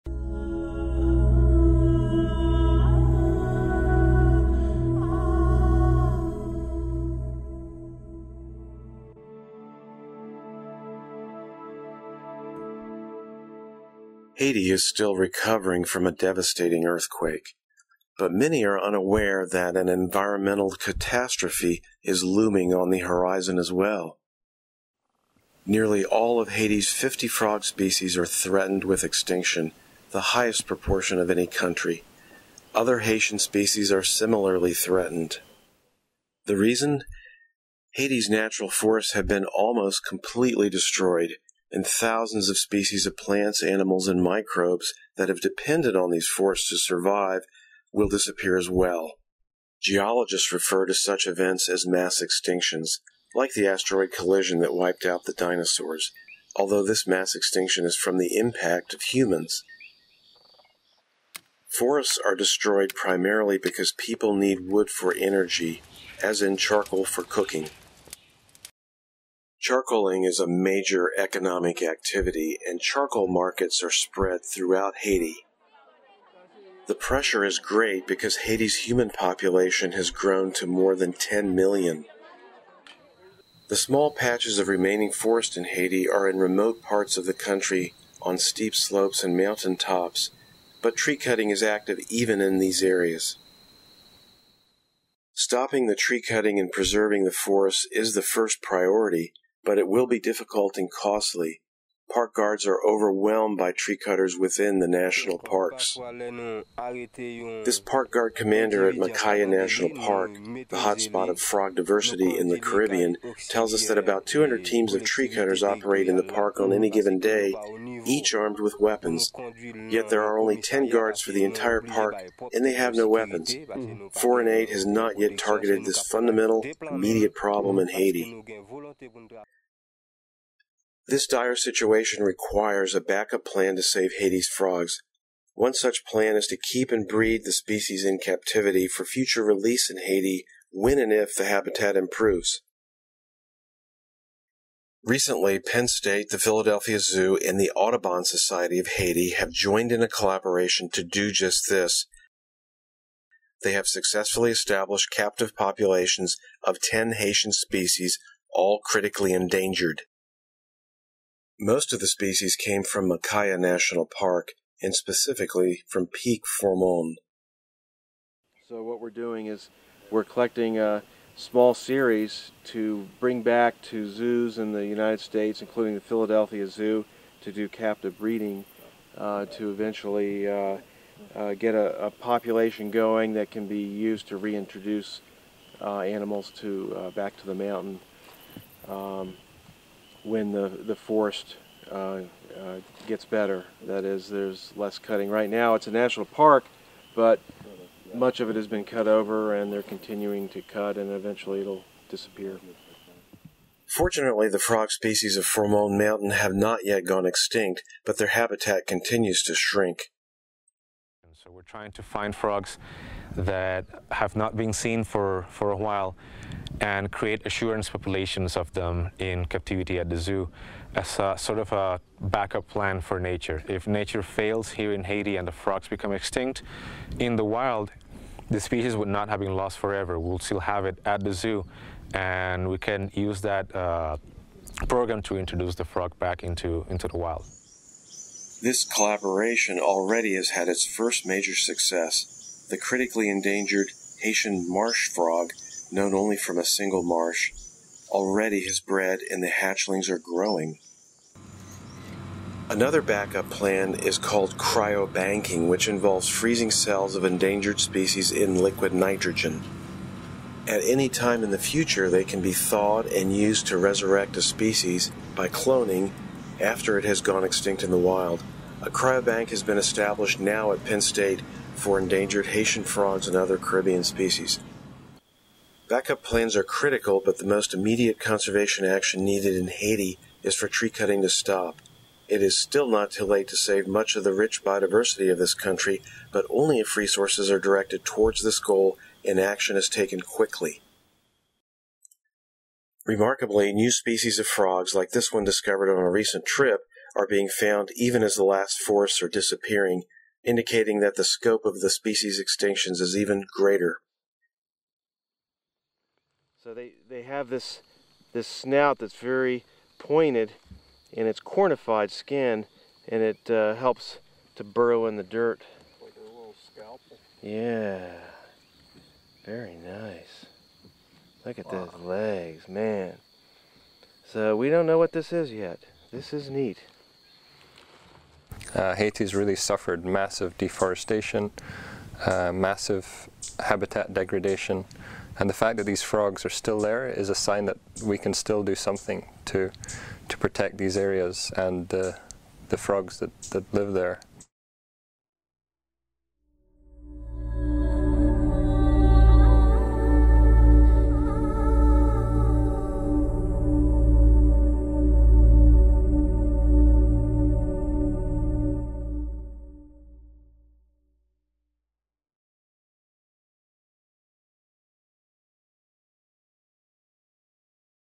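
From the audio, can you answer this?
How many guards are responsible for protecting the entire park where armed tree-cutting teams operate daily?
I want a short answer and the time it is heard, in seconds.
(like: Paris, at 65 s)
10, at 120 s.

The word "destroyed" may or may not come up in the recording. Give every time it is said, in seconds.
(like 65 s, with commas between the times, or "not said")
40 s, 62 s.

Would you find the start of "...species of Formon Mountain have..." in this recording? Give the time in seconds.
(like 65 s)
204 s.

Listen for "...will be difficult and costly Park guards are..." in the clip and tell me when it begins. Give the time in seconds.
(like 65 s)
99 s.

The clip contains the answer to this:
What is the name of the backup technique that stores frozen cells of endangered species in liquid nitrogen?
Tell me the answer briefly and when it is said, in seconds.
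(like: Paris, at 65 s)
Cryobanking, at 254 s.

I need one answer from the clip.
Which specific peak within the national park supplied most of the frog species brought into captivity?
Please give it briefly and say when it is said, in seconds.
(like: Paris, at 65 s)
Peak Formon, at 166 s.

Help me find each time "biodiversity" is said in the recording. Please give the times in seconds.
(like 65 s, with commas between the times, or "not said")
284 s.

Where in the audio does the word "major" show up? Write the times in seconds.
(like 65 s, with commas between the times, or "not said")
70 s, 241 s.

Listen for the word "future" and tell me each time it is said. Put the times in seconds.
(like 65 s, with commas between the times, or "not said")
139 s, 261 s.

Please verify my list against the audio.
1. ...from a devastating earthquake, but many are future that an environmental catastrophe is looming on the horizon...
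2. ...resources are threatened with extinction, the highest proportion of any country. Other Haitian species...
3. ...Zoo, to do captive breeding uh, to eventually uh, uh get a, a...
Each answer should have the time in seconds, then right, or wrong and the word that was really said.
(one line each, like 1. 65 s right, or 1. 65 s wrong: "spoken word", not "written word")
1. 15 s wrong: "unaware", not "future"
2. 27 s wrong: "species", not "resources"
3. 176 s right.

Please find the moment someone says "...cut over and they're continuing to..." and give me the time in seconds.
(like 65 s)
198 s.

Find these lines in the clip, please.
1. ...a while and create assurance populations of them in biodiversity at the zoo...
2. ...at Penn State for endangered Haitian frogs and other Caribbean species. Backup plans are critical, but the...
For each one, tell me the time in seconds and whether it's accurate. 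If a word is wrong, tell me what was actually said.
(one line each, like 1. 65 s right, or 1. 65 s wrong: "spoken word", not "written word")
1. 215 s wrong: "captivity", not "biodiversity"
2. 270 s right.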